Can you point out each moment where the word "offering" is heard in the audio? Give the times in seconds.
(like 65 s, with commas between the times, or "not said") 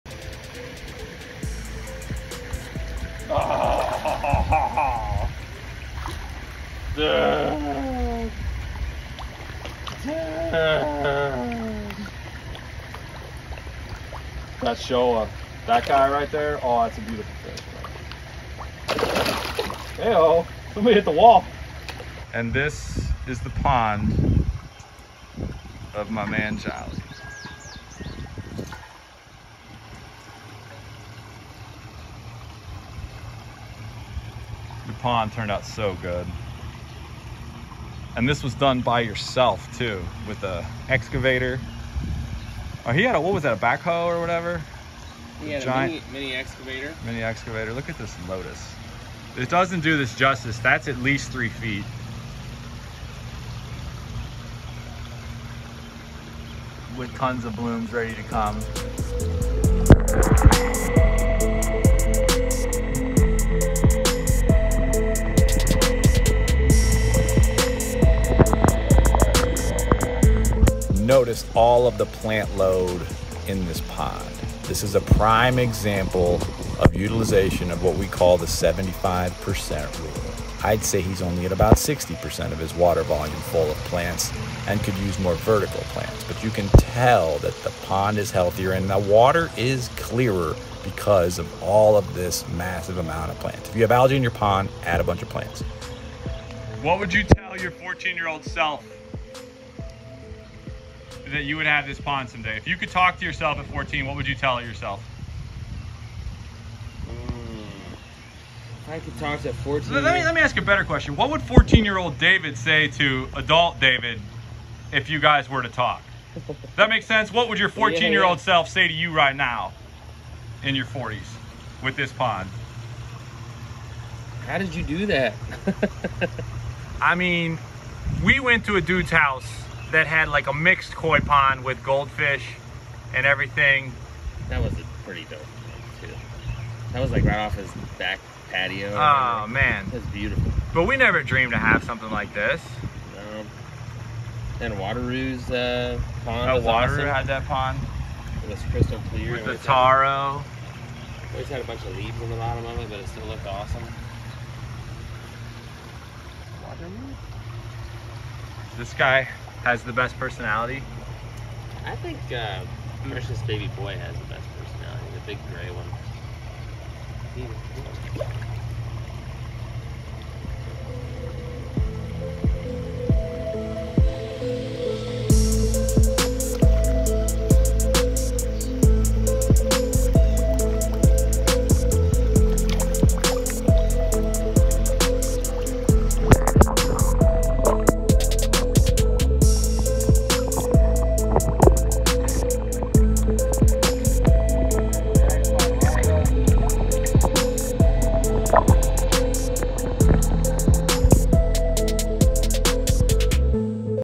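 not said.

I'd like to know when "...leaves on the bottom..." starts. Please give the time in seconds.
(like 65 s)
151 s.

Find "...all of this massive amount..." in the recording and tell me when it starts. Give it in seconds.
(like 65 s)
91 s.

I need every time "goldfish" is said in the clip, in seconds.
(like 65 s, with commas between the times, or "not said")
131 s.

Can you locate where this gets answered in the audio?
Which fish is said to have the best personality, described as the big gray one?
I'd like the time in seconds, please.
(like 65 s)
163 s.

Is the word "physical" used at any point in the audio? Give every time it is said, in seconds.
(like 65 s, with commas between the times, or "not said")
not said.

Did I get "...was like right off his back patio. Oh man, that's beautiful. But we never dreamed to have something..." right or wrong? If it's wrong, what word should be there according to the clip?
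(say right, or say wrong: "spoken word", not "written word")
right.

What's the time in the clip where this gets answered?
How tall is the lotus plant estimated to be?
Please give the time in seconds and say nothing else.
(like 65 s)
51 s.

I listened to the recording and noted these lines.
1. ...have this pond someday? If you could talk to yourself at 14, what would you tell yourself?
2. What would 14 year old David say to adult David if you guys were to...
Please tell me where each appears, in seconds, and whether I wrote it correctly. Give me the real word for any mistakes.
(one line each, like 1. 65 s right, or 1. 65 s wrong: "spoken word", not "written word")
1. 101 s right
2. 111 s right.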